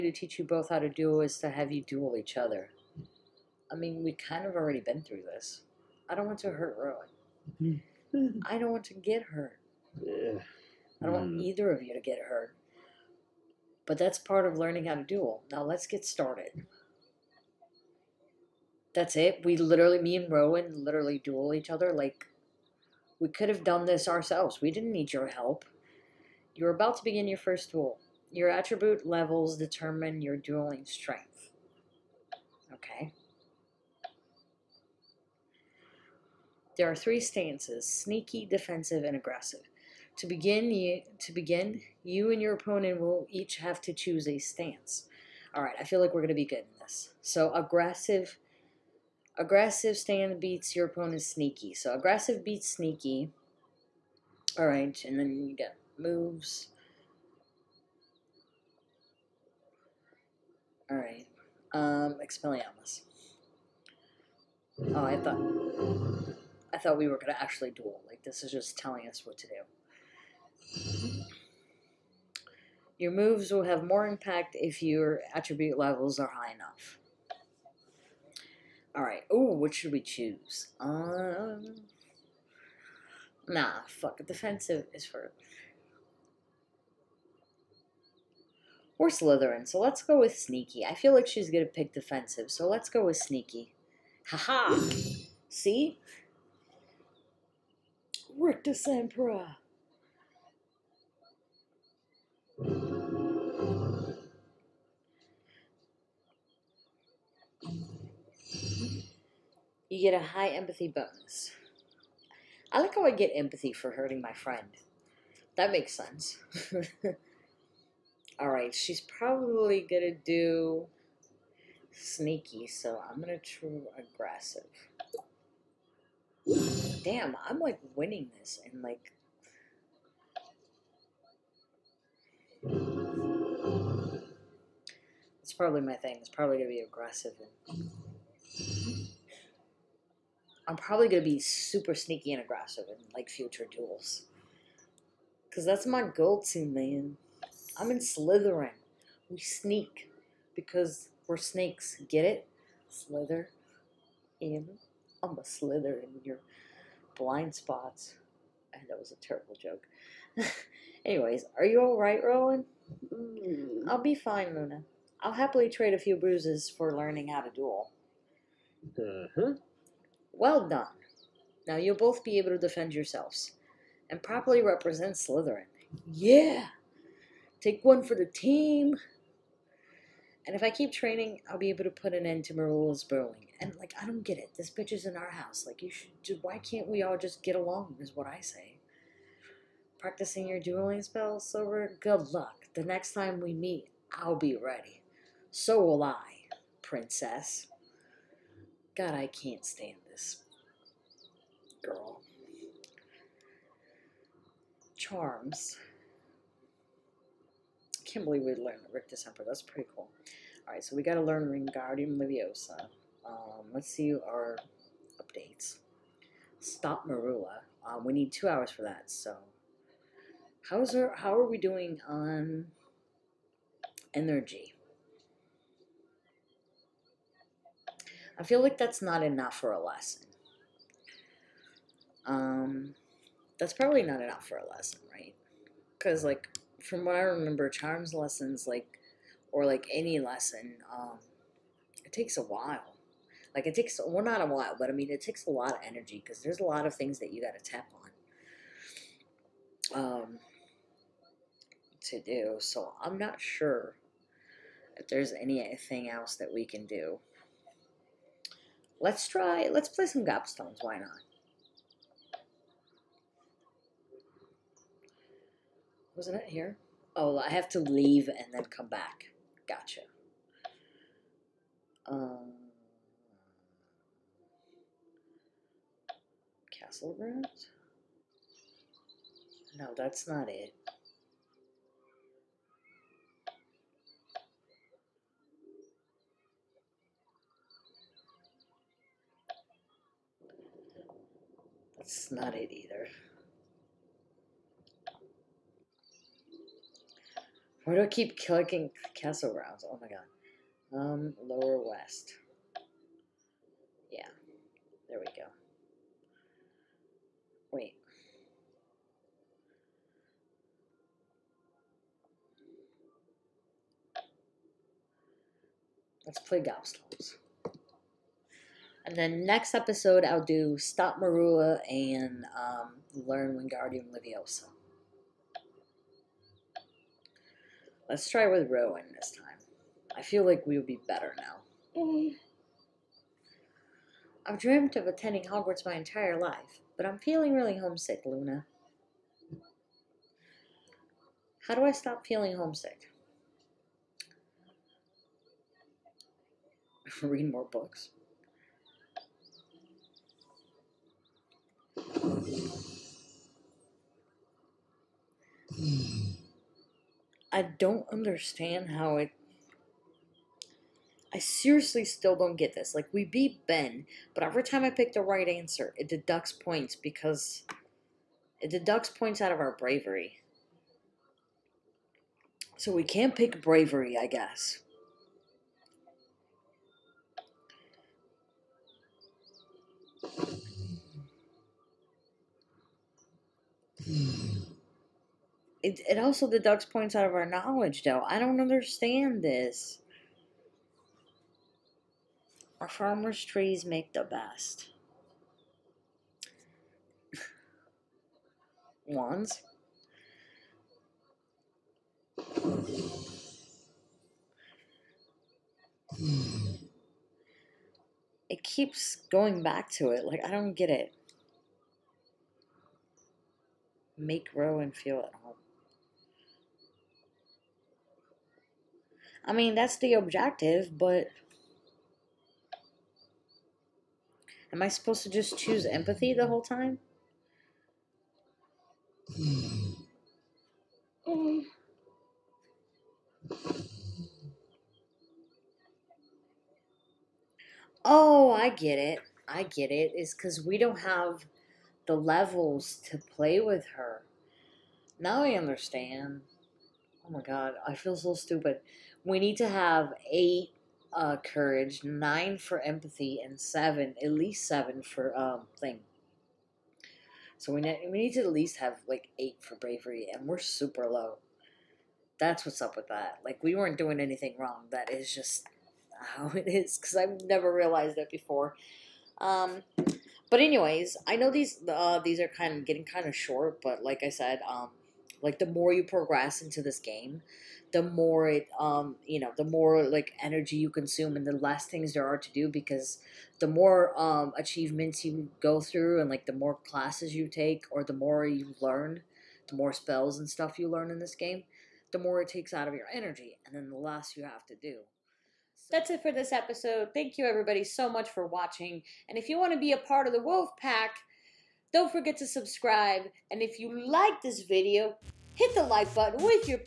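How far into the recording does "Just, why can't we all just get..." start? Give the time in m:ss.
3:06.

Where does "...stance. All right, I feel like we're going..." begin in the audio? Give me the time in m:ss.
0:44.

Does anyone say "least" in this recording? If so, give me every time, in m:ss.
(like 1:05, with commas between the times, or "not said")
7:34, 7:38.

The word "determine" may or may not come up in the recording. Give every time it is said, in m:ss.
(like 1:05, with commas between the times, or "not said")
0:29.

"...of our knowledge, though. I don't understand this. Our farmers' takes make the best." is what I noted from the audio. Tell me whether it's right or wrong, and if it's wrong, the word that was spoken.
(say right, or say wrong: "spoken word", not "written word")
wrong: "trees", not "takes".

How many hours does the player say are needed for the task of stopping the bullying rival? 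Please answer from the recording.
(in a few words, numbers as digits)
2.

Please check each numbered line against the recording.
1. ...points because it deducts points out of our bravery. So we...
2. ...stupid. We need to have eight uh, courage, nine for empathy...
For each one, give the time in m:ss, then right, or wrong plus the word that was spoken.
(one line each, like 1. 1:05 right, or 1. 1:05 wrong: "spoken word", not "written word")
1. 6:06 right
2. 7:28 right.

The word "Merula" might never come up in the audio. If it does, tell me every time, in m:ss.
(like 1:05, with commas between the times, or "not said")
3:02, 3:37, 5:21.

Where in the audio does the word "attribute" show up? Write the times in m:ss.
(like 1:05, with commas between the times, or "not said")
0:28, 1:15.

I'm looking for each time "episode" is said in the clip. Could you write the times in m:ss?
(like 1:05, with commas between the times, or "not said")
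5:19, 8:16.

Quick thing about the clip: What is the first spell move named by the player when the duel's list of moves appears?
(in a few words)
Expelliarmus.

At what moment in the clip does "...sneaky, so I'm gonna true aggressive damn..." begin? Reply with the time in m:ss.
2:01.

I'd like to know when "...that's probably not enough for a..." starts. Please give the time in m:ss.
3:53.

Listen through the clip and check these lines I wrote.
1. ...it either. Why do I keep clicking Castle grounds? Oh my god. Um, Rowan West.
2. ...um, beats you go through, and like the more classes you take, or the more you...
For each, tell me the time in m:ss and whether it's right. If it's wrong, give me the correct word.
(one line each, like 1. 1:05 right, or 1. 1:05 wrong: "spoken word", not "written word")
1. 4:52 wrong: "Lower", not "Rowan"
2. 8:04 wrong: "achievements", not "beats".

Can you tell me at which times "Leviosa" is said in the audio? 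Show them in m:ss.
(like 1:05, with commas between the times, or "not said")
3:32, 5:24.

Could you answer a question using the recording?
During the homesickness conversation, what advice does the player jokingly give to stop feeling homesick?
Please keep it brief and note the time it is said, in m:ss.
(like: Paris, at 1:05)
read more books, at 5:47.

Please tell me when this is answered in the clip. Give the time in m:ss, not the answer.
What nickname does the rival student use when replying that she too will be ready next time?
3:16.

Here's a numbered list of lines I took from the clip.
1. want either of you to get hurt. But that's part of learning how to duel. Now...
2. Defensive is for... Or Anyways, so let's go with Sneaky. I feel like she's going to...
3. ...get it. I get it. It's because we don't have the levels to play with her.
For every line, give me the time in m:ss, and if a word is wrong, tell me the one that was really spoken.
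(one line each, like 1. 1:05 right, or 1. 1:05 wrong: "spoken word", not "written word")
1. 0:11 right
2. 1:24 wrong: "Slytherin", not "Anyways"
3. 7:18 right.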